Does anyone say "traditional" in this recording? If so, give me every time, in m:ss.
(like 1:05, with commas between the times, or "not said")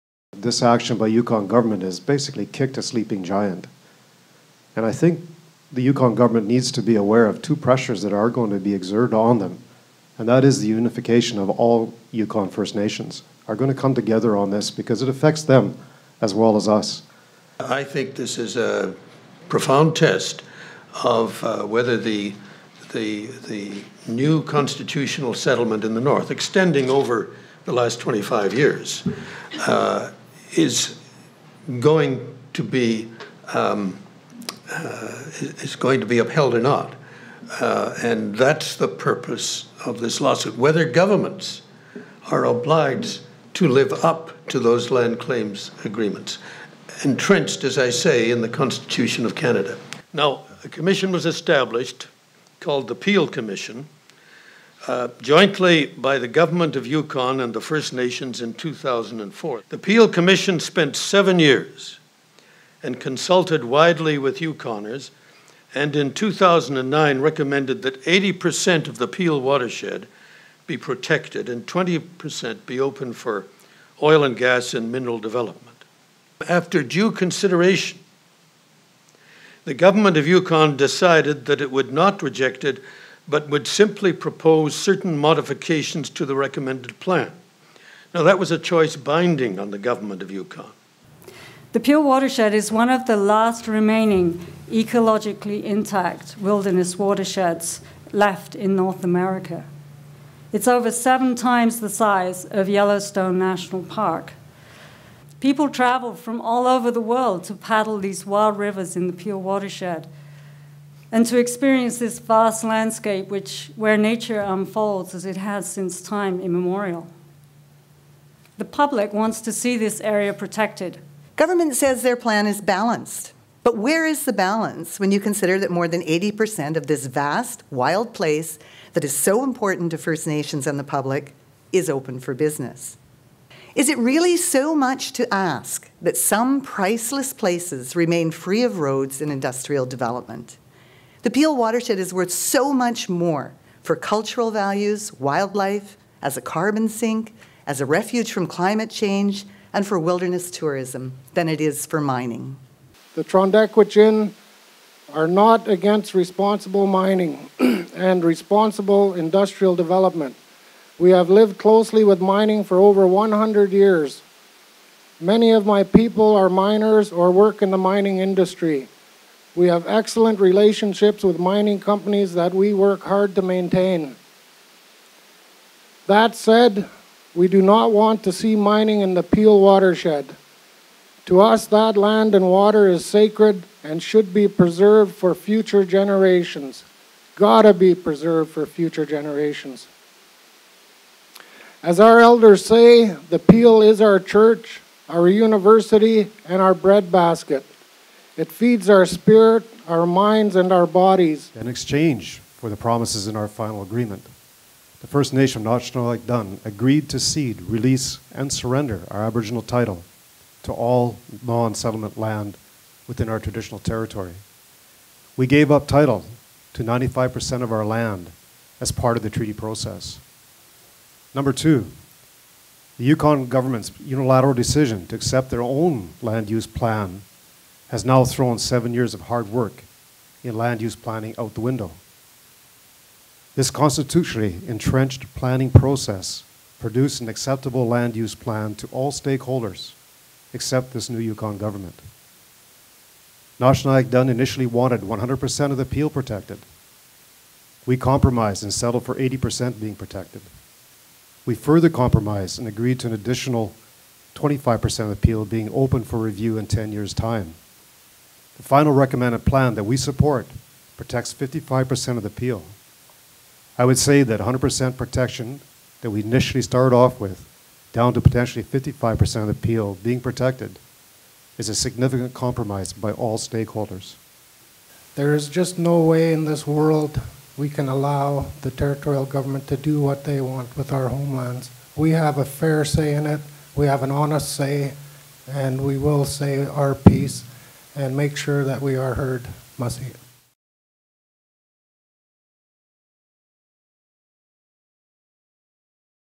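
3:33.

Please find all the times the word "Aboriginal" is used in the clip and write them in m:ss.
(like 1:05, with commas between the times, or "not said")
3:29.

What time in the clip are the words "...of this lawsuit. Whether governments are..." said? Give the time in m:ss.
0:39.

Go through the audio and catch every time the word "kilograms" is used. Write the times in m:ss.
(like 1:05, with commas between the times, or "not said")
not said.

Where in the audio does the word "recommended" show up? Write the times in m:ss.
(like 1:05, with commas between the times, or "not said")
1:07, 1:26, 4:18.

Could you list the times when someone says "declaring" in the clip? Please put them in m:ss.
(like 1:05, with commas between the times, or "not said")
not said.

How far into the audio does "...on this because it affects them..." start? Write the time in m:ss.
0:14.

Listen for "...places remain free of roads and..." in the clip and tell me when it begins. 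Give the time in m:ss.
2:17.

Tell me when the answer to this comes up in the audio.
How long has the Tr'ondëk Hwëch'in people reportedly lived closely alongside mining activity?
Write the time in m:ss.
2:42.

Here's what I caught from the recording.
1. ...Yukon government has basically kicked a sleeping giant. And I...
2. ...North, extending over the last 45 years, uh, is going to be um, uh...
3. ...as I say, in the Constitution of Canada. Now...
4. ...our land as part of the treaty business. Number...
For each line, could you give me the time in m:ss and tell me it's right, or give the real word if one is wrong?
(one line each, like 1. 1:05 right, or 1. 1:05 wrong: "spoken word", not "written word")
1. 0:01 right
2. 0:26 wrong: "25", not "45"
3. 0:47 right
4. 3:37 wrong: "process", not "business".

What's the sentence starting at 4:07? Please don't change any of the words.
We compromised and settled for 80% being protected.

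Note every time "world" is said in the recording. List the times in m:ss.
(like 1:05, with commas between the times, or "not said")
1:46, 4:36.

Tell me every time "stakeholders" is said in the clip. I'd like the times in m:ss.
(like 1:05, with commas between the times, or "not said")
3:59, 4:33.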